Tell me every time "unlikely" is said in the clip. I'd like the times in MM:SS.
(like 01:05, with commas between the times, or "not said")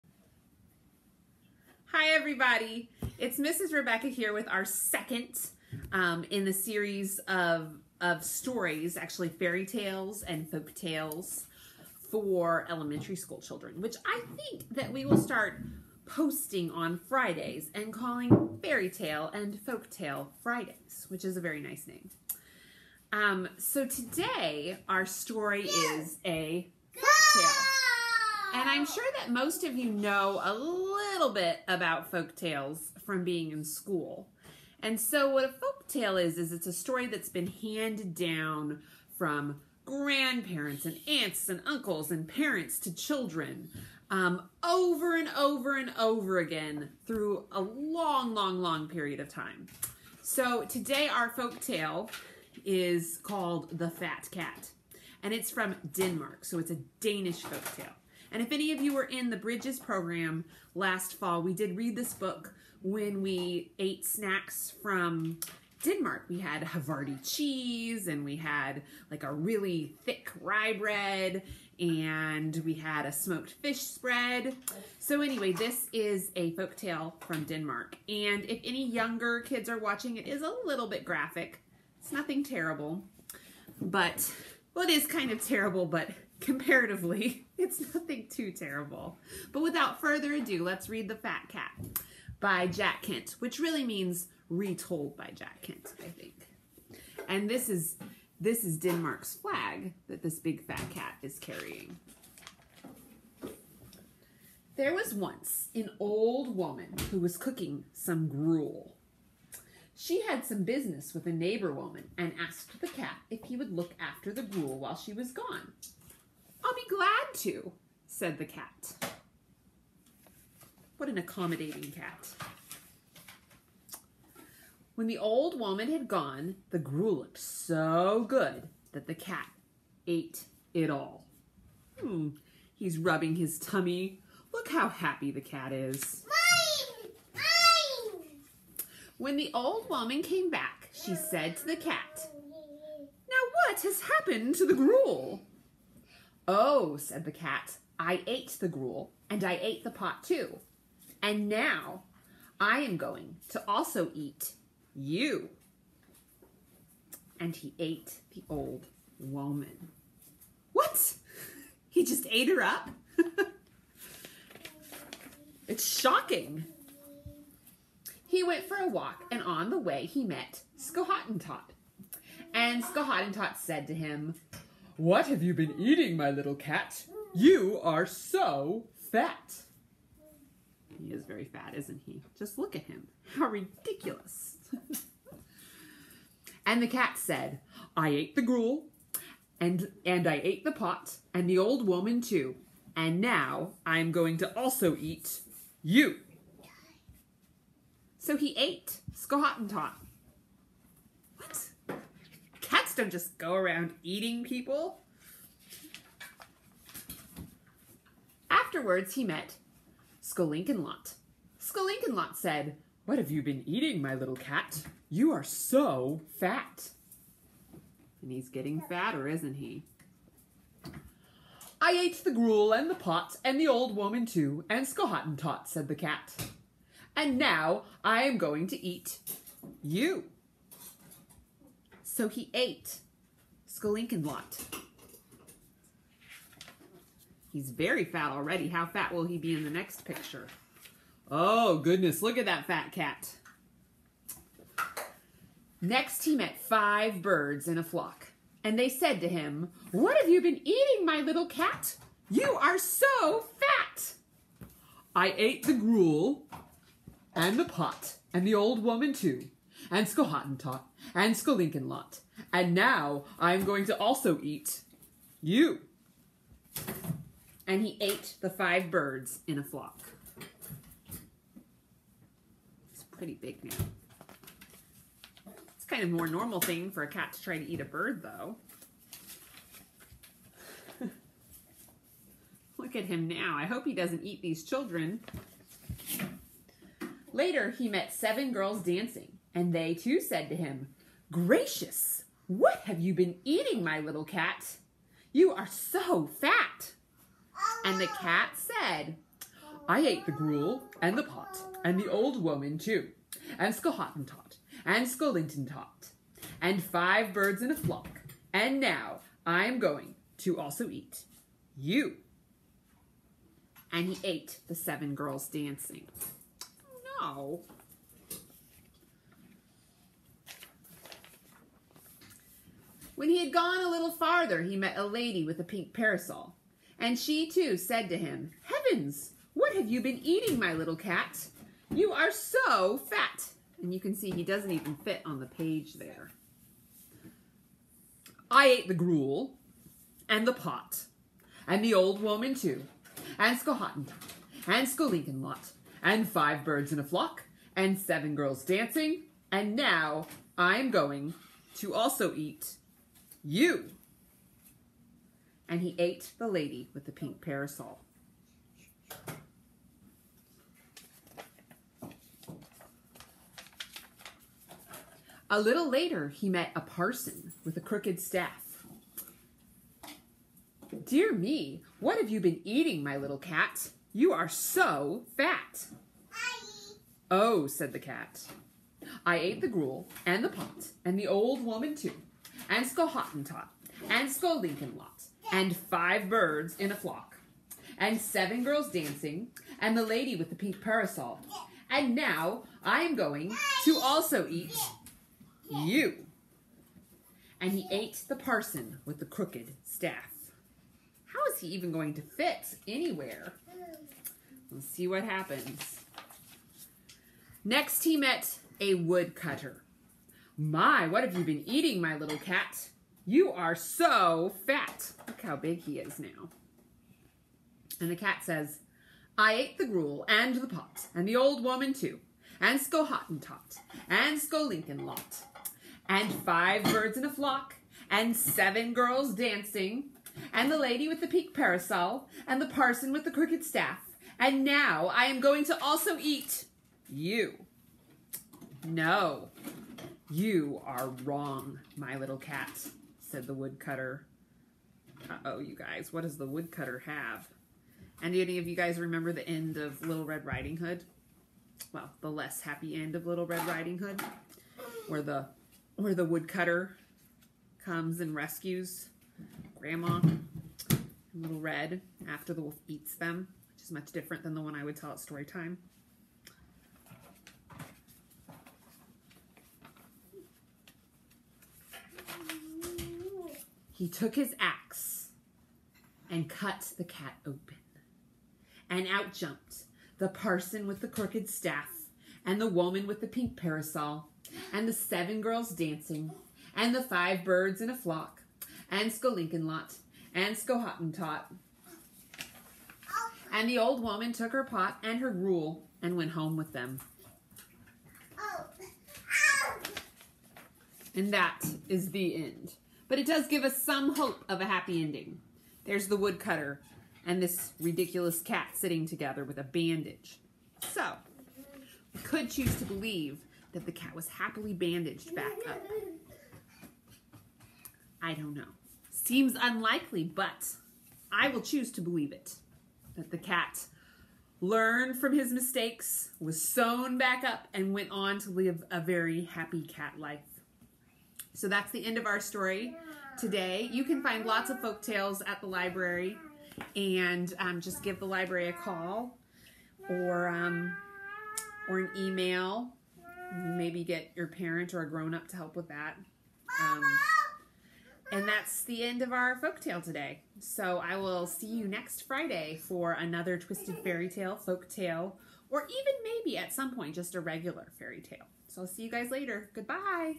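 08:39.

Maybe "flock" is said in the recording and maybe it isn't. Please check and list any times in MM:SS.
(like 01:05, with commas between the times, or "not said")
04:07, 04:29, 05:07, 05:47, 06:26, 07:07, 08:07.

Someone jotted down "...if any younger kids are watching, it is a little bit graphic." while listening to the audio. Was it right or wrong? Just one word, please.
right.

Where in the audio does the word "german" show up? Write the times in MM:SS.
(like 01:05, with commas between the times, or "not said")
not said.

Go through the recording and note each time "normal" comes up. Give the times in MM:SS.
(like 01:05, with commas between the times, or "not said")
04:36.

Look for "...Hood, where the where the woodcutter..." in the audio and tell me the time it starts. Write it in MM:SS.
07:33.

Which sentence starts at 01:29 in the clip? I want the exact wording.
But without further ado, let's read The Fat Cat by Jack Kent, which really means retold by Jack Kent, I think.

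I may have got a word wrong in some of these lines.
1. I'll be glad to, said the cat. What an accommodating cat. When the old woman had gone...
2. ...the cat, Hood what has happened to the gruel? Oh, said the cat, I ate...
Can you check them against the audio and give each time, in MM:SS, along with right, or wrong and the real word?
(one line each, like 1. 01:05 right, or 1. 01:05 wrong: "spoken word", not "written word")
1. 01:56 right
2. 02:21 wrong: "Now", not "Hood".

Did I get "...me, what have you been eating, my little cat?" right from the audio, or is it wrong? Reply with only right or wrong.
right.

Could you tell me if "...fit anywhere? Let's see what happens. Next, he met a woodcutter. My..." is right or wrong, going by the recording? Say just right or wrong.
right.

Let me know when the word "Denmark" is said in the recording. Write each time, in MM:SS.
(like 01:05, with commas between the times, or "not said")
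00:55, 01:05, 01:17, 01:38.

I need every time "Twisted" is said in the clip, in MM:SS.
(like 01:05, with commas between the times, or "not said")
09:13.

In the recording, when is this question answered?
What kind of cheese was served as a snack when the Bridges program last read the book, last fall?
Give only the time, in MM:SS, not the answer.
01:06.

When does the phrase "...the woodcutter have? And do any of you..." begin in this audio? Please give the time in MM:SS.
07:26.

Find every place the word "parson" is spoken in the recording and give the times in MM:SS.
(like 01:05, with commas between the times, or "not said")
06:06, 06:38, 07:12, 08:00.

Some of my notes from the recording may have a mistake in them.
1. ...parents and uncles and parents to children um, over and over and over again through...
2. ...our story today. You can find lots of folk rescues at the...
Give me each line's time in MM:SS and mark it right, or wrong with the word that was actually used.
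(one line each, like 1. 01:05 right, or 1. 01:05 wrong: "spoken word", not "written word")
1. 00:41 wrong: "aunts", not "parents"
2. 08:52 wrong: "tales", not "rescues".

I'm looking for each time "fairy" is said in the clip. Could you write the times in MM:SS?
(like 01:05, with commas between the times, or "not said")
00:09, 00:18, 09:13, 09:17.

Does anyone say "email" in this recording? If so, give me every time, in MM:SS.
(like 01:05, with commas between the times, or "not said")
09:02.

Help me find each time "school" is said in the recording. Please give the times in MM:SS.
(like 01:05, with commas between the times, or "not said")
00:13, 00:33.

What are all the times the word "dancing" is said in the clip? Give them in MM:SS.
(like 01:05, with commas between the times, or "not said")
04:48, 05:15, 05:48, 06:28, 07:09, 08:05.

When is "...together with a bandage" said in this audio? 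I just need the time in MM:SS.
08:29.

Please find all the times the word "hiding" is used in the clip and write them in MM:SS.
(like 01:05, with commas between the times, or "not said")
not said.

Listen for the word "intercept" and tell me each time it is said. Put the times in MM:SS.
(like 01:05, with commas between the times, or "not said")
not said.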